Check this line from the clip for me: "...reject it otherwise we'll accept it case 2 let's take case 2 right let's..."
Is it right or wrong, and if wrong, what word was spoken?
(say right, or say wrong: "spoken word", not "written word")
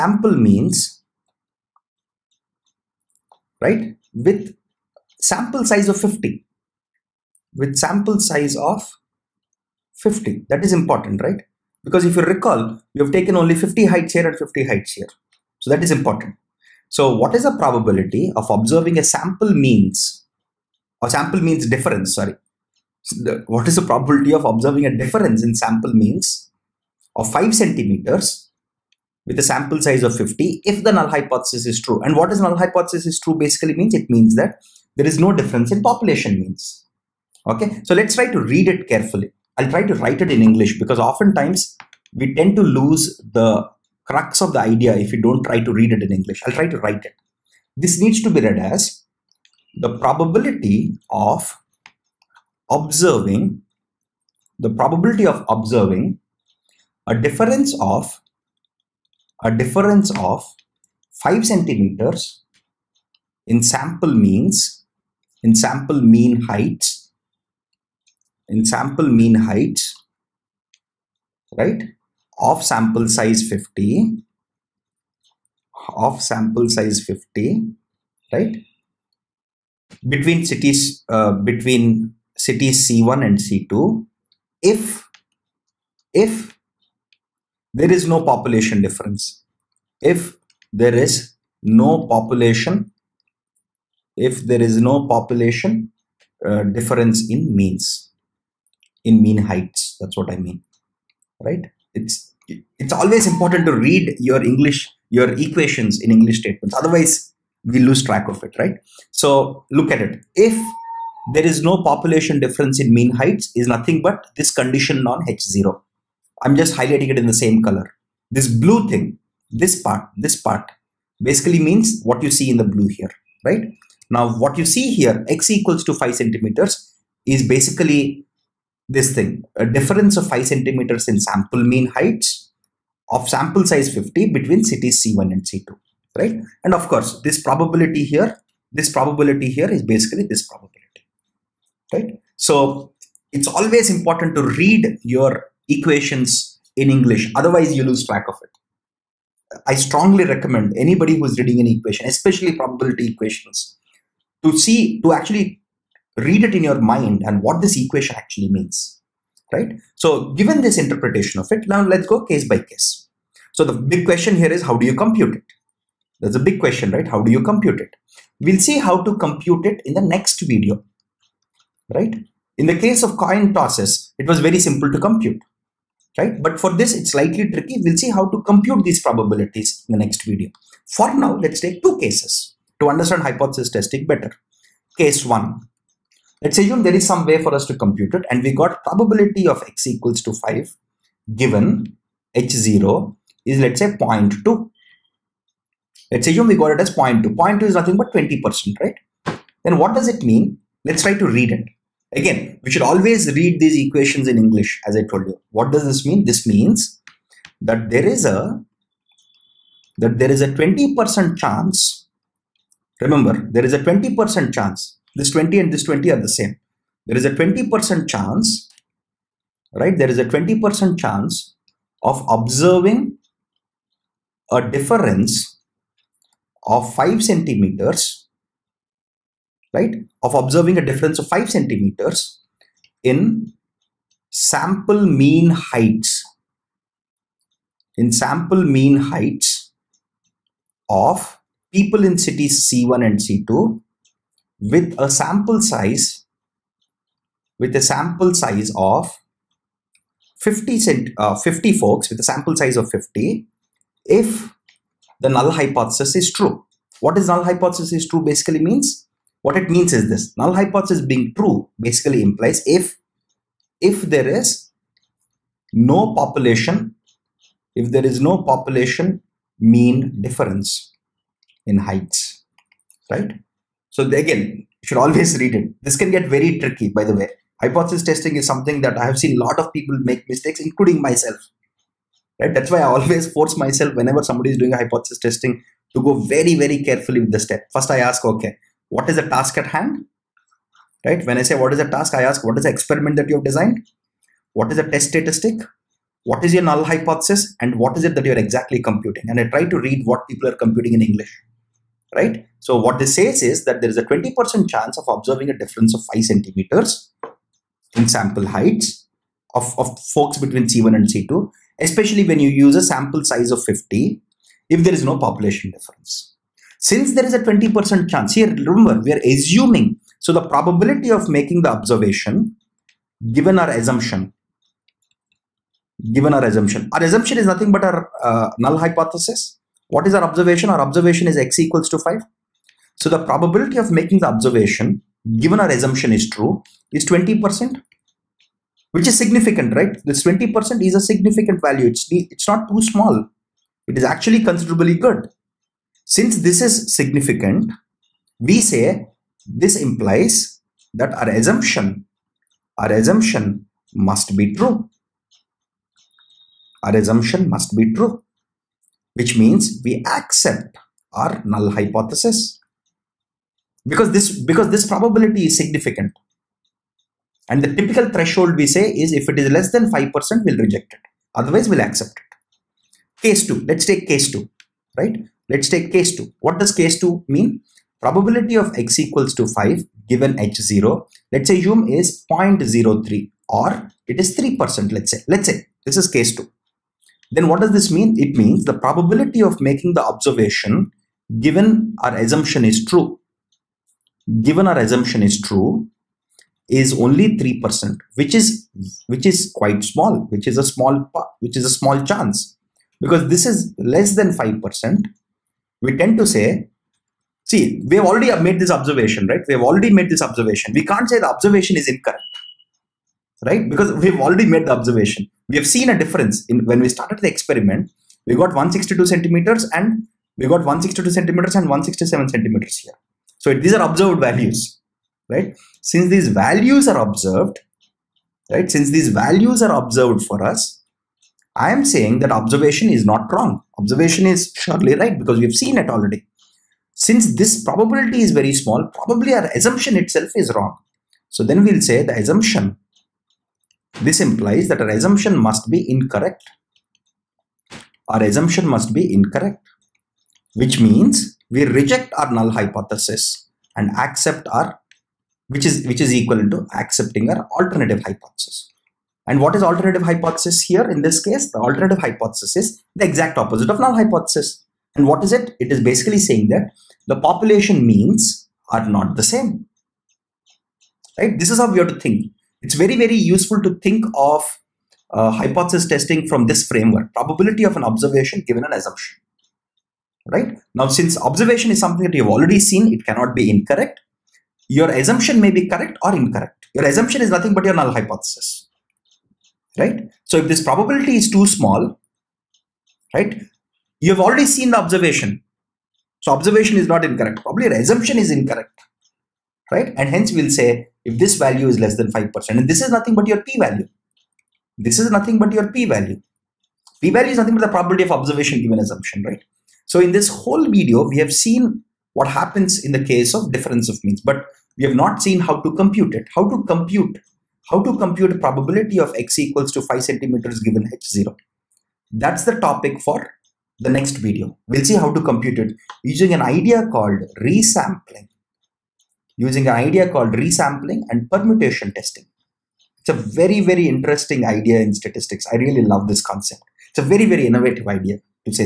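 right.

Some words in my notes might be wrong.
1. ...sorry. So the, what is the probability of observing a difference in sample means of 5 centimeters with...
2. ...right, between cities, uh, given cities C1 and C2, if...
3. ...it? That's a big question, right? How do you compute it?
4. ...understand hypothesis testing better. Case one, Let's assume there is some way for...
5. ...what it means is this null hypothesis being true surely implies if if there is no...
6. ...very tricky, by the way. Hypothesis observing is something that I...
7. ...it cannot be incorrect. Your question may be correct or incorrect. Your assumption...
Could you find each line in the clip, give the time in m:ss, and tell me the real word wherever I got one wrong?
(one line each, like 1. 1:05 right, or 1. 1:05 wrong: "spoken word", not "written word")
1. 0:22 right
2. 1:18 wrong: "between", not "given"
3. 2:45 right
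4. 3:02 right
5. 4:19 wrong: "basically", not "surely"
6. 4:36 wrong: "testing", not "observing"
7. 8:02 wrong: "assumption", not "question".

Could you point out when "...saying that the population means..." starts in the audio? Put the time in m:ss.
7:46.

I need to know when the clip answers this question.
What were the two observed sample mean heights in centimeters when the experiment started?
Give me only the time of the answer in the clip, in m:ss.
7:00.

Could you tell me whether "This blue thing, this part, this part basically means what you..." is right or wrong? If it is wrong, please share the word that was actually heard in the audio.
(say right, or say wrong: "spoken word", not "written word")
right.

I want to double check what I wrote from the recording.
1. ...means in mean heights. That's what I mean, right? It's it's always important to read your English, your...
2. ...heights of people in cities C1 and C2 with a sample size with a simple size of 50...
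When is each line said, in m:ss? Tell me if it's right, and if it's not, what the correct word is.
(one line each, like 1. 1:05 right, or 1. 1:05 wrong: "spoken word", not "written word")
1. 1:37 right
2. 3:58 wrong: "sample", not "simple".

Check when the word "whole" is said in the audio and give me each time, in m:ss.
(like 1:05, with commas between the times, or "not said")
8:30.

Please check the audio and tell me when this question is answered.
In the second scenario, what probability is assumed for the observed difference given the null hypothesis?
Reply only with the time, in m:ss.
6:22.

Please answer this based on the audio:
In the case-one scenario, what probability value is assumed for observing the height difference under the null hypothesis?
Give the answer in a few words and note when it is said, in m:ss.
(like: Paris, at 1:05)
0.2, at 3:13.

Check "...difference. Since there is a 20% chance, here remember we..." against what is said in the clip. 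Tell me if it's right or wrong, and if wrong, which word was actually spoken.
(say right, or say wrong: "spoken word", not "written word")
right.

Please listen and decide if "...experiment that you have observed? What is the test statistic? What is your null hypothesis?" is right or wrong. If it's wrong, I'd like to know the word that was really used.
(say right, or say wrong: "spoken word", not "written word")
wrong: "designed", not "observed".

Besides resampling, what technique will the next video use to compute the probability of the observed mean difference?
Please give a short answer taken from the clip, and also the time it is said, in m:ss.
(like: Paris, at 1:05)
permutation testing, at 8:51.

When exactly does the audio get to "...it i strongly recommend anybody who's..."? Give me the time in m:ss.
2:28.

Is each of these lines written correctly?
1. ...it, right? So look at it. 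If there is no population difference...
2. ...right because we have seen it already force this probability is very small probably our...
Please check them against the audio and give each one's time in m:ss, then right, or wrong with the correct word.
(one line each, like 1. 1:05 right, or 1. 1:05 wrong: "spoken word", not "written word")
1. 1:48 right
2. 7:14 wrong: "since", not "force".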